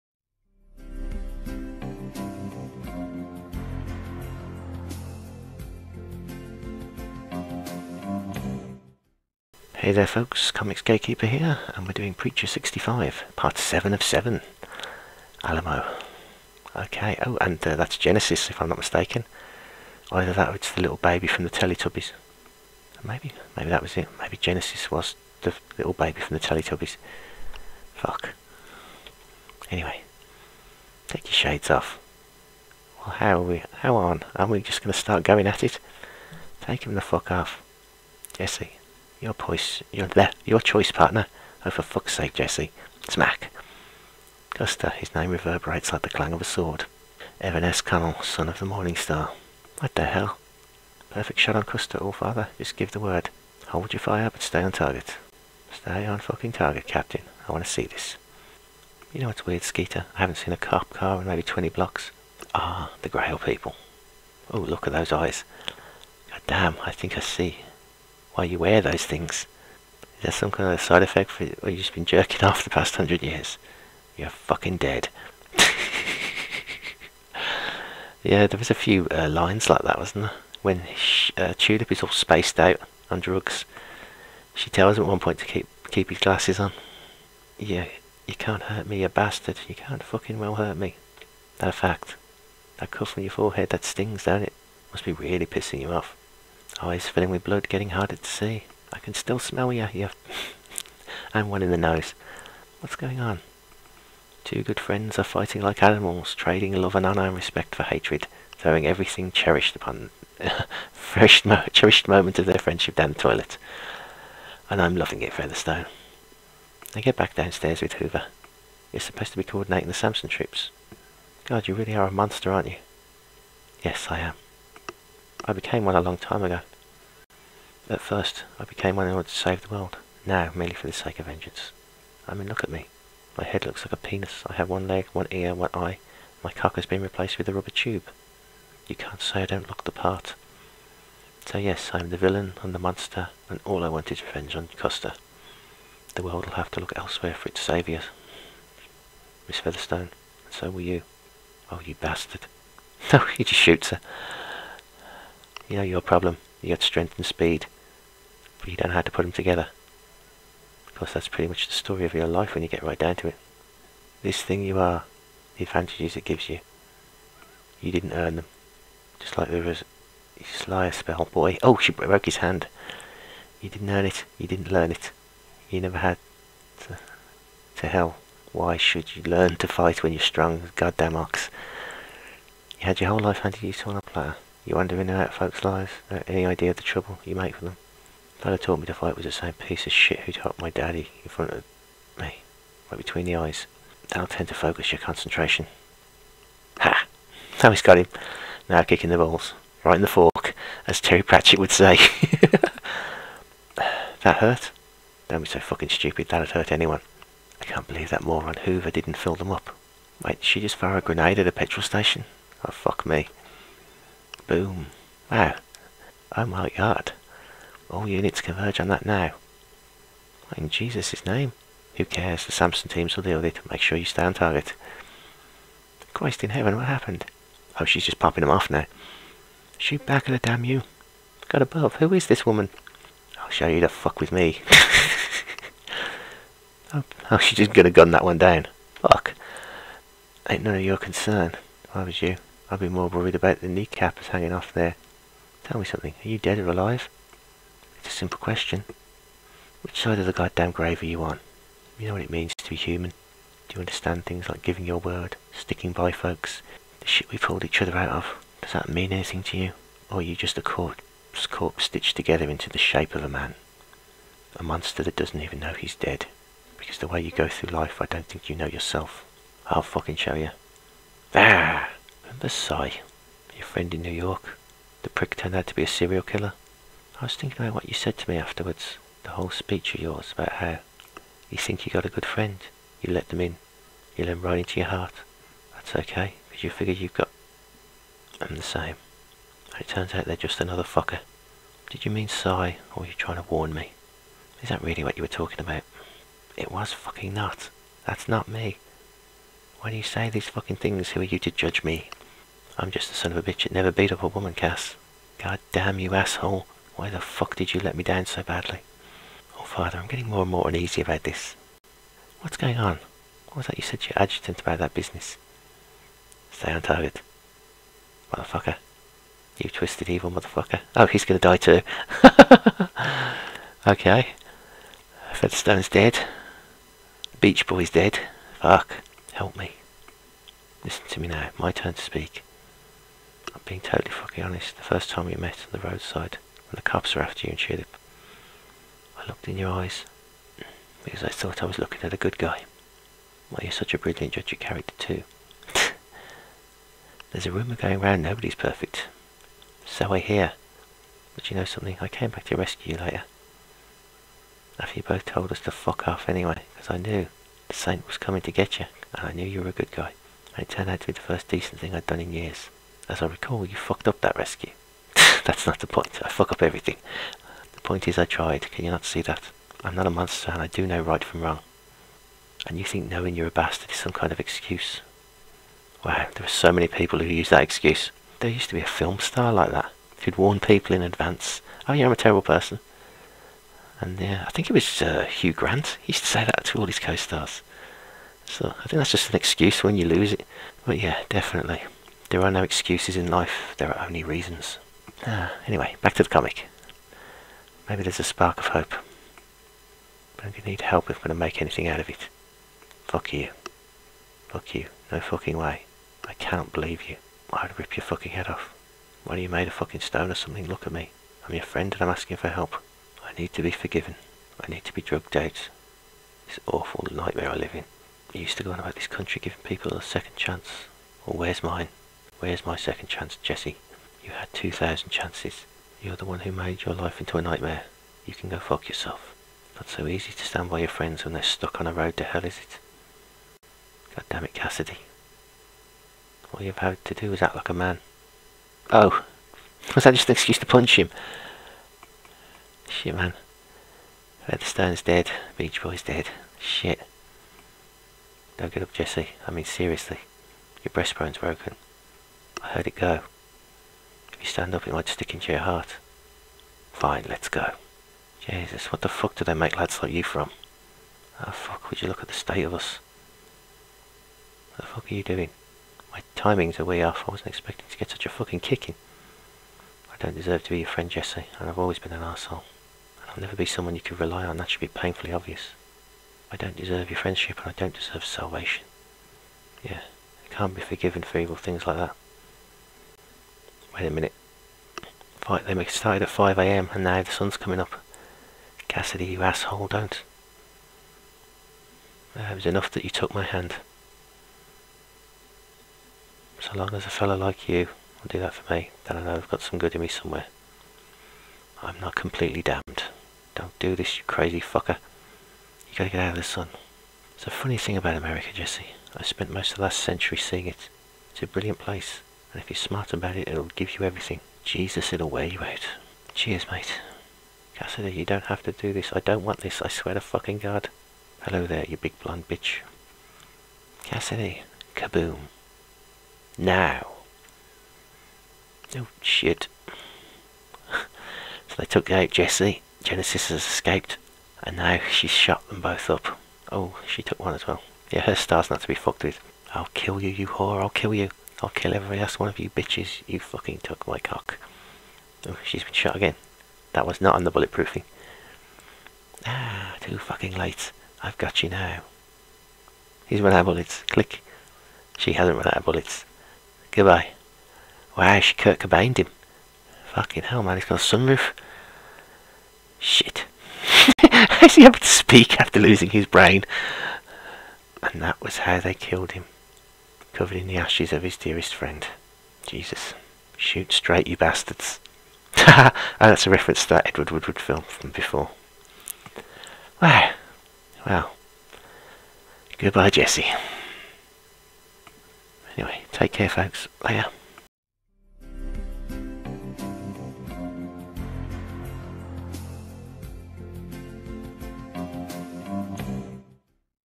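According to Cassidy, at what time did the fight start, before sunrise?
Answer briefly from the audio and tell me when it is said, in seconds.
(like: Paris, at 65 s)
5am, at 486 s.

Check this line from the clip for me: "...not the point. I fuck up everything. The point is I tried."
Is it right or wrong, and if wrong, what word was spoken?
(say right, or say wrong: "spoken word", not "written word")
right.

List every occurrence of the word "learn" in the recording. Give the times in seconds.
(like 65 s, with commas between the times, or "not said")
174 s, 179 s.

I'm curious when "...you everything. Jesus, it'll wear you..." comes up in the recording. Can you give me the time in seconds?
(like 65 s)
513 s.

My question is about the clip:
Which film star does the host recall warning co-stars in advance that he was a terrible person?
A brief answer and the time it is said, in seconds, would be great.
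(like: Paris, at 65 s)
Hugh Grant, at 385 s.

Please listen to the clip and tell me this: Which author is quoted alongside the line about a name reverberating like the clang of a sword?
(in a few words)
Evan S. Connell.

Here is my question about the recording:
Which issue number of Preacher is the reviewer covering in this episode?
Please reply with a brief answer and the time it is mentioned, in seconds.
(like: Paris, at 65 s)
65, at 12 s.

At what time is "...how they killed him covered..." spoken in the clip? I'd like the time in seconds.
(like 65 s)
568 s.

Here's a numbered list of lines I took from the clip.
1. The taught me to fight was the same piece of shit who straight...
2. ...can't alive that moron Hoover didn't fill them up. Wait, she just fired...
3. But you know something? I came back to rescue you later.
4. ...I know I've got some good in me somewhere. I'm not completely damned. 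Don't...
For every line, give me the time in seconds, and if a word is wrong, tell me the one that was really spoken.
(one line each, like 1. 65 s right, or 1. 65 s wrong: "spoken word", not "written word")
1. 188 s wrong: "taught", not "straight"
2. 207 s wrong: "believe", not "alive"
3. 351 s right
4. 499 s right.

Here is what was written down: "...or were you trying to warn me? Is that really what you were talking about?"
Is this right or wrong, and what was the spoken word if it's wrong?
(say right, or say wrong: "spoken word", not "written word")
right.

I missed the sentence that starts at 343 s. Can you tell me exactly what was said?
Well, you're such a brilliant judge of character too.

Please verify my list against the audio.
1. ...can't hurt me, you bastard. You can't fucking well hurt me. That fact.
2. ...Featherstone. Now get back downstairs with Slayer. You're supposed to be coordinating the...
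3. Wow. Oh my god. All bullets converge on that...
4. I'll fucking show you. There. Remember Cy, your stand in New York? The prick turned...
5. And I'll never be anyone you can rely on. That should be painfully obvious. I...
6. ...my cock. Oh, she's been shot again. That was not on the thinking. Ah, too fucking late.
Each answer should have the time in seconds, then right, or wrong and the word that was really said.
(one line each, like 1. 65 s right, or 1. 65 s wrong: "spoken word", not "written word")
1. 88 s right
2. 115 s wrong: "Hoover", not "Slayer"
3. 215 s wrong: "units", not "bullets"
4. 269 s wrong: "friend", not "stand"
5. 473 s wrong: "someone", not "anyone"
6. 544 s wrong: "bulletproofing", not "thinking".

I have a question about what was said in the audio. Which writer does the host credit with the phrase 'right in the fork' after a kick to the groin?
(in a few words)
Terry Pratchett.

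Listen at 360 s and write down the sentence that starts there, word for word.
And it turned out to be the first decent thing I'd done in years.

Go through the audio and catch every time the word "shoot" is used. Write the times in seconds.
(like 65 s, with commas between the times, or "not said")
153 s, 229 s, 573 s.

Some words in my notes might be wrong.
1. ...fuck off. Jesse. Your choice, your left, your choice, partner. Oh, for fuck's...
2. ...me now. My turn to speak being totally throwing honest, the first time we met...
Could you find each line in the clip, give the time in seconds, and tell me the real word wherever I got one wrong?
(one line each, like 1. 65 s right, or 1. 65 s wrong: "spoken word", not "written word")
1. 37 s right
2. 331 s wrong: "fucking", not "throwing".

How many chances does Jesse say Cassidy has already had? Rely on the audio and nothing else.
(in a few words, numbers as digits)
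2,000.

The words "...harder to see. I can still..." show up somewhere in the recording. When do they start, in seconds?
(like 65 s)
97 s.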